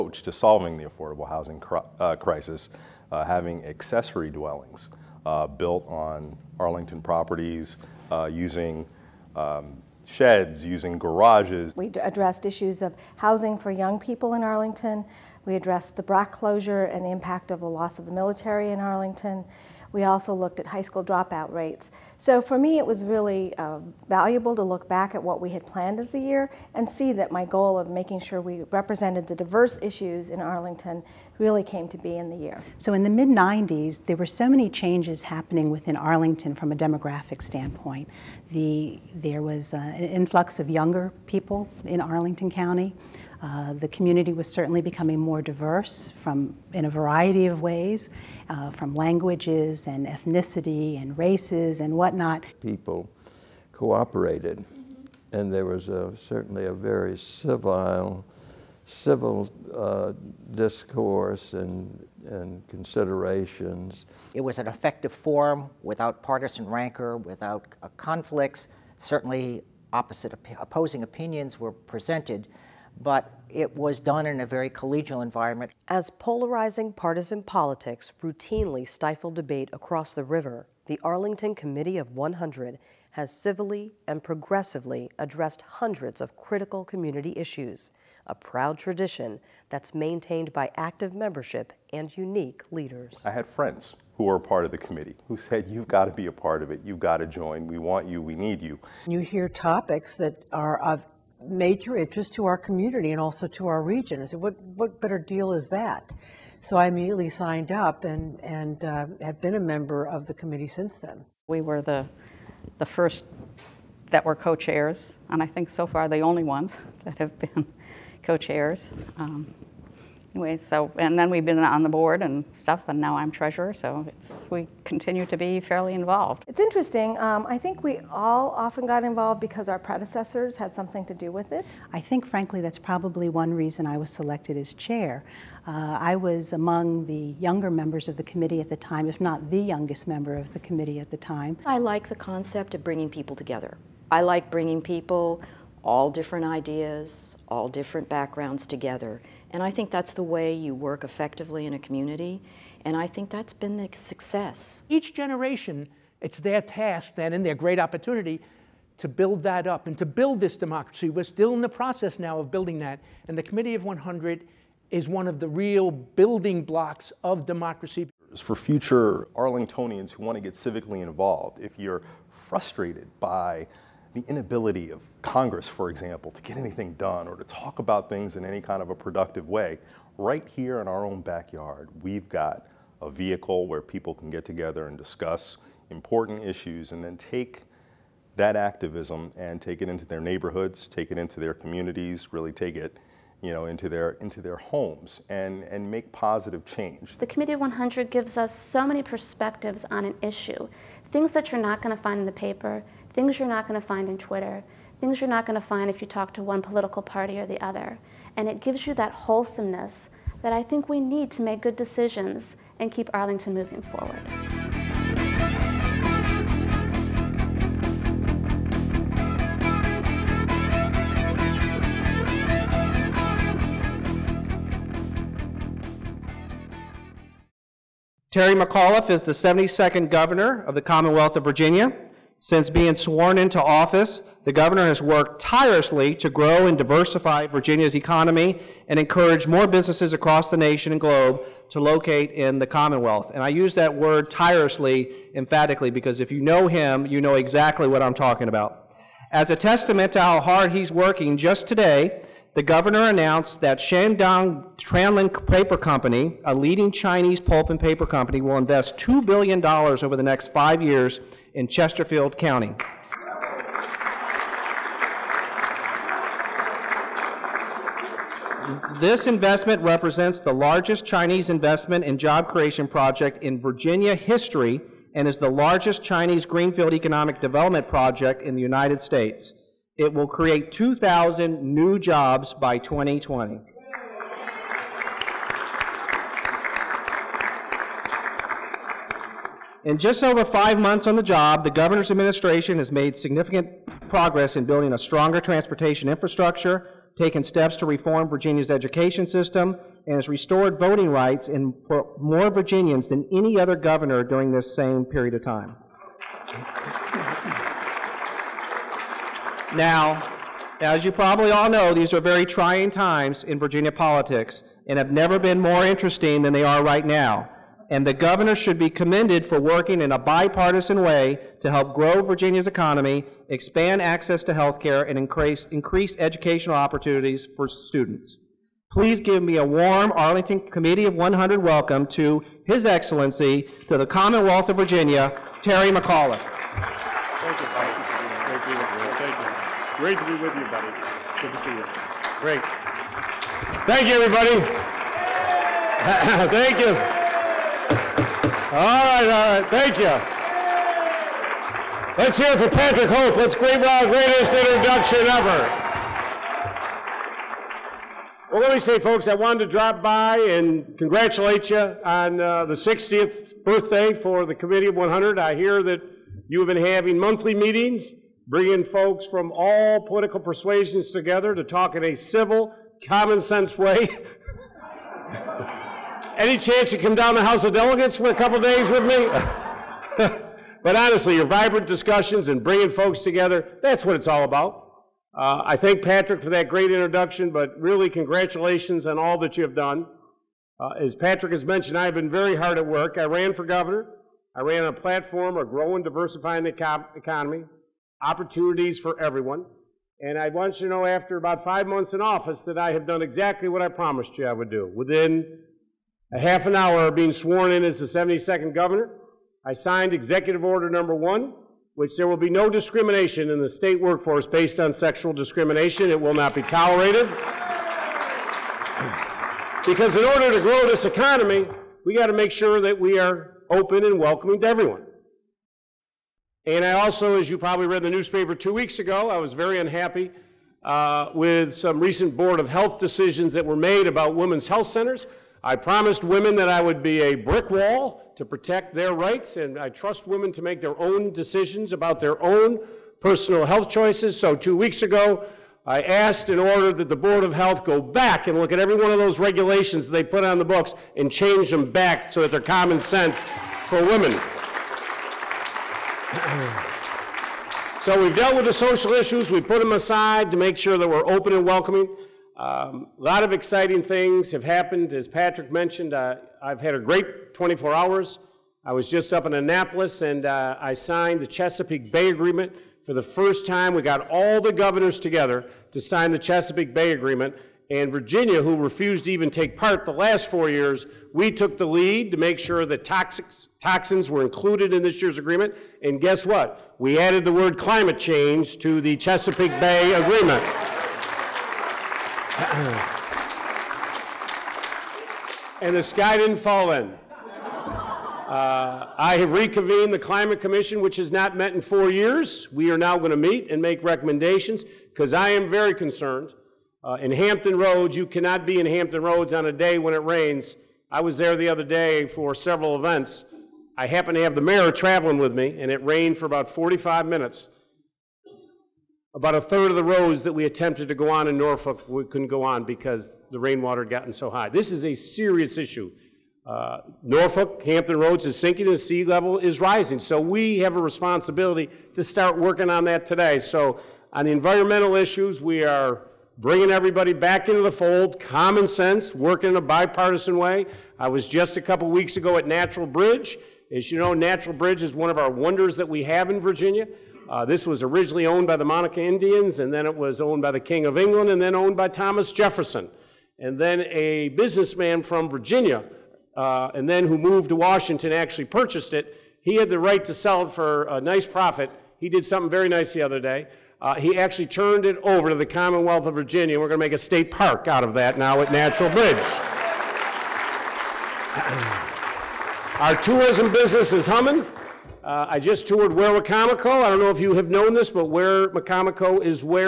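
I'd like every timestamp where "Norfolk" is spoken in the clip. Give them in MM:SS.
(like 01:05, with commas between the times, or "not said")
08:41, 08:47.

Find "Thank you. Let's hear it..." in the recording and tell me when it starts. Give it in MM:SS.
05:49.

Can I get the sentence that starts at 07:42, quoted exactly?
Um, a lot of exciting things have happened.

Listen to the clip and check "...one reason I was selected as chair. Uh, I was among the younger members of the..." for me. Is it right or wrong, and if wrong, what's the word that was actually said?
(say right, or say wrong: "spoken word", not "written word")
right.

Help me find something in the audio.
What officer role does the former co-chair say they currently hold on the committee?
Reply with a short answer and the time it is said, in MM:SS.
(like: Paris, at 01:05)
Treasurer, at 02:03.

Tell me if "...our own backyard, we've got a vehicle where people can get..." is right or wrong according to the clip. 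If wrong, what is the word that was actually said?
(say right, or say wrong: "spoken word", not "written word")
right.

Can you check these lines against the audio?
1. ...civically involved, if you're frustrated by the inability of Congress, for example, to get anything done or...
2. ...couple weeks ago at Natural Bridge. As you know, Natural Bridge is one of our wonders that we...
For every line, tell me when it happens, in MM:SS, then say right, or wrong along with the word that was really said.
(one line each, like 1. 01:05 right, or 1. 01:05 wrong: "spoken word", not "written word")
1. 02:50 right
2. 09:01 right.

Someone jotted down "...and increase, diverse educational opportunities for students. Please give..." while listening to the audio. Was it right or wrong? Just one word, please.
wrong.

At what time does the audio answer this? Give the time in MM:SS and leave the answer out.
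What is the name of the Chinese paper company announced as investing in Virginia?
04:13.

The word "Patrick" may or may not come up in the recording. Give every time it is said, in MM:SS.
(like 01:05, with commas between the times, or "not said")
05:52, 06:26, 06:31, 07:45.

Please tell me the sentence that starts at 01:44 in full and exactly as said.
I said, what, what better deal is that?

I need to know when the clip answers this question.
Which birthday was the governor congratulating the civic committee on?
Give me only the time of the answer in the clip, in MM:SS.
06:02.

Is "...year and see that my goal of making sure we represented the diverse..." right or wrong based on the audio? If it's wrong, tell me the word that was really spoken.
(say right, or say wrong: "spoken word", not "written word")
right.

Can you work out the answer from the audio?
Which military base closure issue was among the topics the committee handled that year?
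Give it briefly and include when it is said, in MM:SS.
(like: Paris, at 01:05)
BRAC, at 00:16.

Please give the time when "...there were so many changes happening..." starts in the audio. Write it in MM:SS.
00:34.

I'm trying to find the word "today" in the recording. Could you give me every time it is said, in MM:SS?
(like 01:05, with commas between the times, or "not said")
04:11, 08:53.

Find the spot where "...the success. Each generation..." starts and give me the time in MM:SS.
02:33.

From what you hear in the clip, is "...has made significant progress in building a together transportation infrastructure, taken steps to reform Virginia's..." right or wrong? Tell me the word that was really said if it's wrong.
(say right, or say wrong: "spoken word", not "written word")
wrong: "stronger", not "together".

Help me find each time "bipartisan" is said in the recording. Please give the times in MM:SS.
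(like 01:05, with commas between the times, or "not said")
05:20, 08:59.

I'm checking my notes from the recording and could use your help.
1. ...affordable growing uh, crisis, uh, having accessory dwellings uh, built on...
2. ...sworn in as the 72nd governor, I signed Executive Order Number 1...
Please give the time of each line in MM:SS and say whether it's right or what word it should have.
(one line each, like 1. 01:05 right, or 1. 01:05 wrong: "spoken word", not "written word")
1. 00:00 wrong: "housing", not "growing"
2. 06:47 right.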